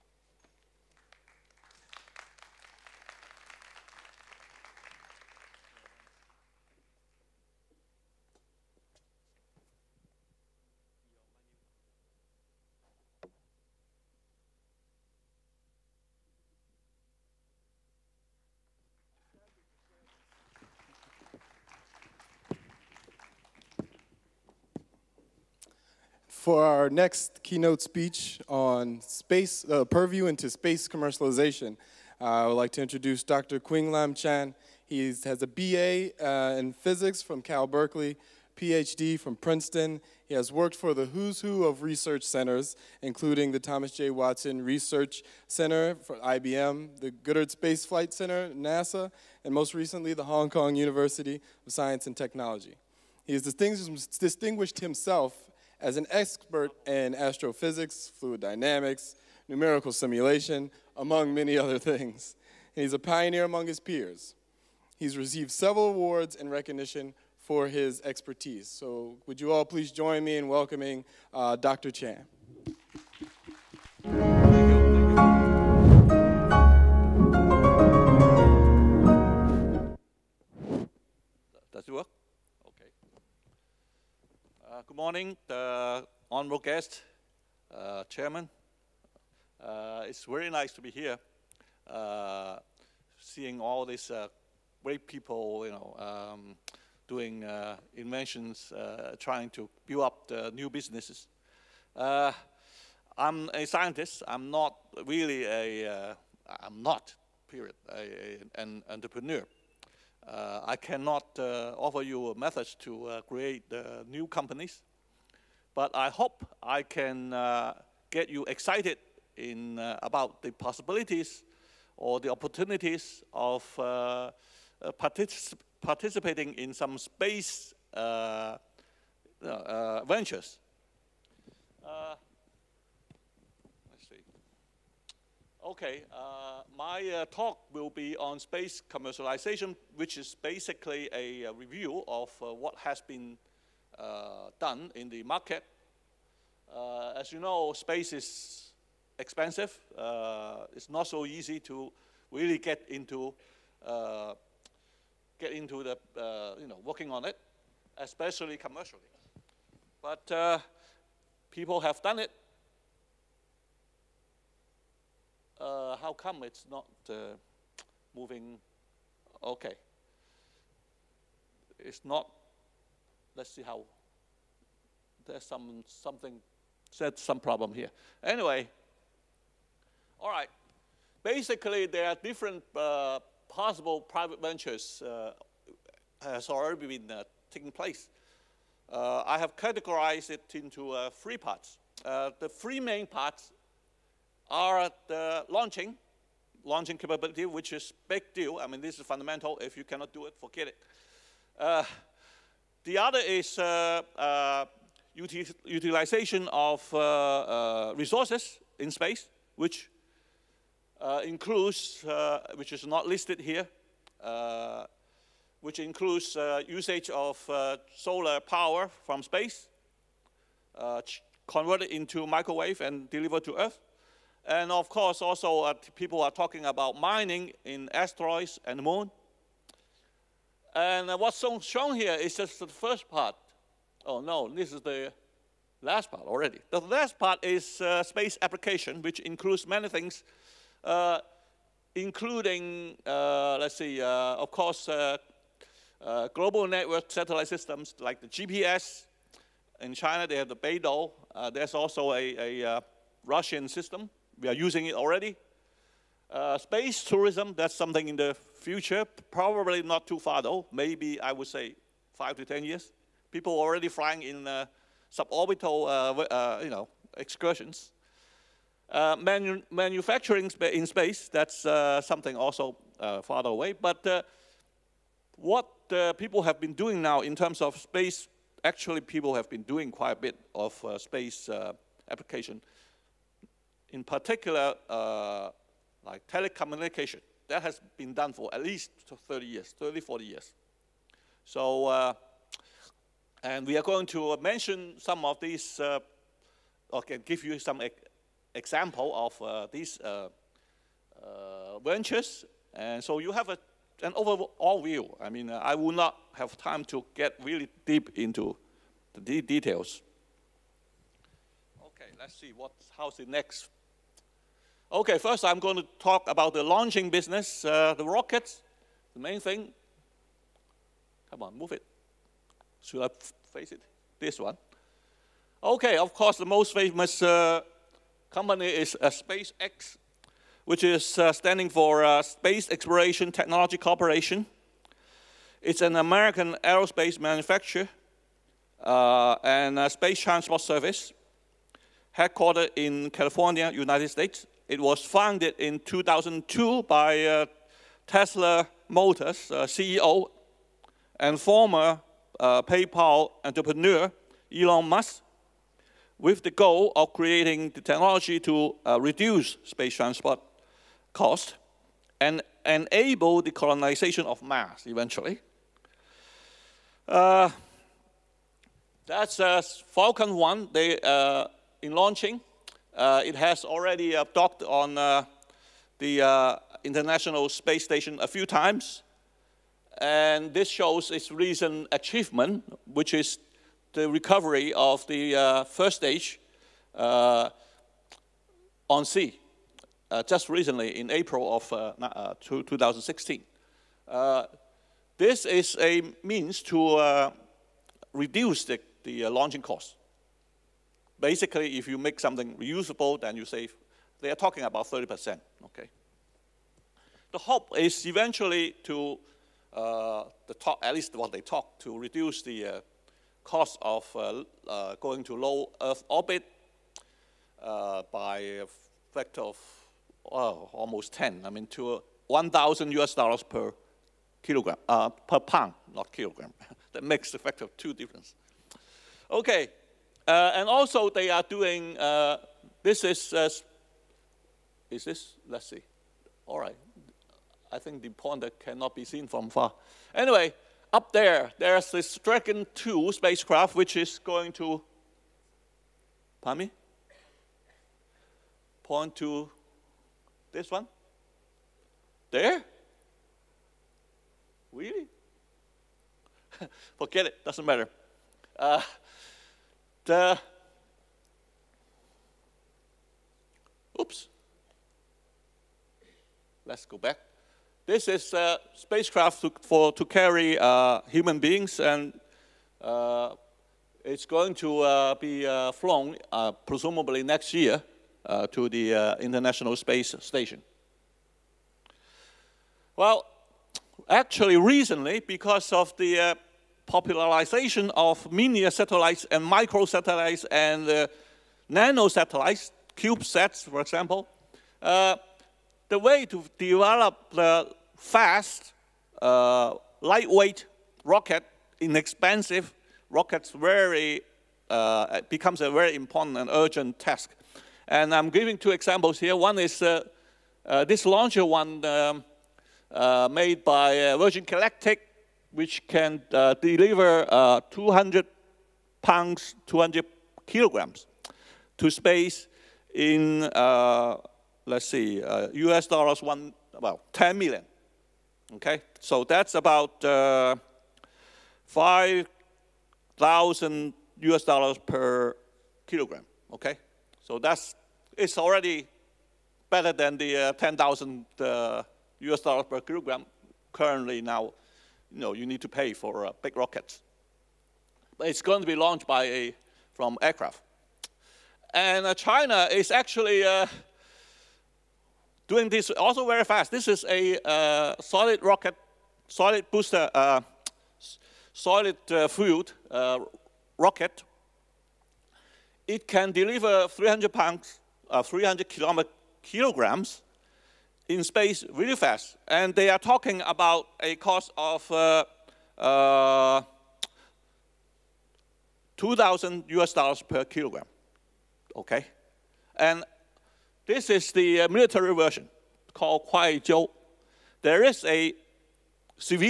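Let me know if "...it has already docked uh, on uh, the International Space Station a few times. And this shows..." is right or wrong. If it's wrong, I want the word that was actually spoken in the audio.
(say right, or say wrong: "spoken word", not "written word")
right.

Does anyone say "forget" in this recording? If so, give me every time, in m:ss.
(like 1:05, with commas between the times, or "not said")
3:20, 7:36.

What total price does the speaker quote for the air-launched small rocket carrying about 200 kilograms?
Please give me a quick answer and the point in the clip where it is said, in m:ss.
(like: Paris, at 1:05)
10 million US dollars, at 8:47.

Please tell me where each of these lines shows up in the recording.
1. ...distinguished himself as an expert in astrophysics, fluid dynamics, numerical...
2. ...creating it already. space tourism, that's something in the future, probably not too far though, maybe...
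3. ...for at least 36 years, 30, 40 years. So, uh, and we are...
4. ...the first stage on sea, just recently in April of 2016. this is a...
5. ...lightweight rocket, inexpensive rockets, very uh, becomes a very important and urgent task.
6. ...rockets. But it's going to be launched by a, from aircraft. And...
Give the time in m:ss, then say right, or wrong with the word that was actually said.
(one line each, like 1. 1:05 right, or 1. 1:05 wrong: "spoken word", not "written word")
1. 0:53 right
2. 4:14 wrong: "using", not "creating"
3. 4:48 wrong: "30", not "36"
4. 6:25 right
5. 8:20 right
6. 9:06 right.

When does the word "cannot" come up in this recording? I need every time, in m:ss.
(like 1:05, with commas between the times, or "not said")
1:50, 3:19, 7:18.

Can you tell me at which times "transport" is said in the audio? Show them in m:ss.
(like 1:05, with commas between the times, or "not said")
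5:40, 5:59.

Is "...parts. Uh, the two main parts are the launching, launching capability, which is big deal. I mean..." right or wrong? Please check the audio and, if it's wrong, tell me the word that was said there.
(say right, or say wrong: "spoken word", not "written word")
wrong: "three", not "two".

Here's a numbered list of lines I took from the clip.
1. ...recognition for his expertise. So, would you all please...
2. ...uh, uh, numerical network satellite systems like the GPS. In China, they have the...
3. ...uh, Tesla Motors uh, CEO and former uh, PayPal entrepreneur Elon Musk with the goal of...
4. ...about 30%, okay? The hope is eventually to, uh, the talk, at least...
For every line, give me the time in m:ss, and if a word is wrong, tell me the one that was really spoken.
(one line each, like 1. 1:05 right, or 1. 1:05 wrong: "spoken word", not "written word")
1. 1:06 right
2. 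4:04 wrong: "global", not "numerical"
3. 5:47 right
4. 6:44 right.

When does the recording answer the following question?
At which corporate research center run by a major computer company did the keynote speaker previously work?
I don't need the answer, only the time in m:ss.
0:43.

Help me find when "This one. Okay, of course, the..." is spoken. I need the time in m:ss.
5:24.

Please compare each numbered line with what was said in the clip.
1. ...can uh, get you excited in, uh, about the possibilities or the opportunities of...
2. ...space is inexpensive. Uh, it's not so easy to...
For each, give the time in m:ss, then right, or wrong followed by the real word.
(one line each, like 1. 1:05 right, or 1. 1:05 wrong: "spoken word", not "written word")
1. 1:56 right
2. 2:27 wrong: "expensive", not "inexpensive".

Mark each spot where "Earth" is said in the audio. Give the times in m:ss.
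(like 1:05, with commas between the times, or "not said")
3:43, 6:55.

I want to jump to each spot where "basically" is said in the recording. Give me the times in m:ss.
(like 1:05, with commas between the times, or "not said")
2:20, 3:01, 6:41.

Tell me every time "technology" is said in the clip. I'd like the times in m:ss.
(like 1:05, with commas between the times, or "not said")
0:52, 5:33, 5:57.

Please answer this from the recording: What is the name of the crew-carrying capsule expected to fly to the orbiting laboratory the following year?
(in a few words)
Dragon 2.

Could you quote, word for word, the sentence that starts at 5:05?
I mean, uh, I will not have time to get really deep into the de details.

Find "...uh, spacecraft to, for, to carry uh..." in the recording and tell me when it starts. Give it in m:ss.
7:48.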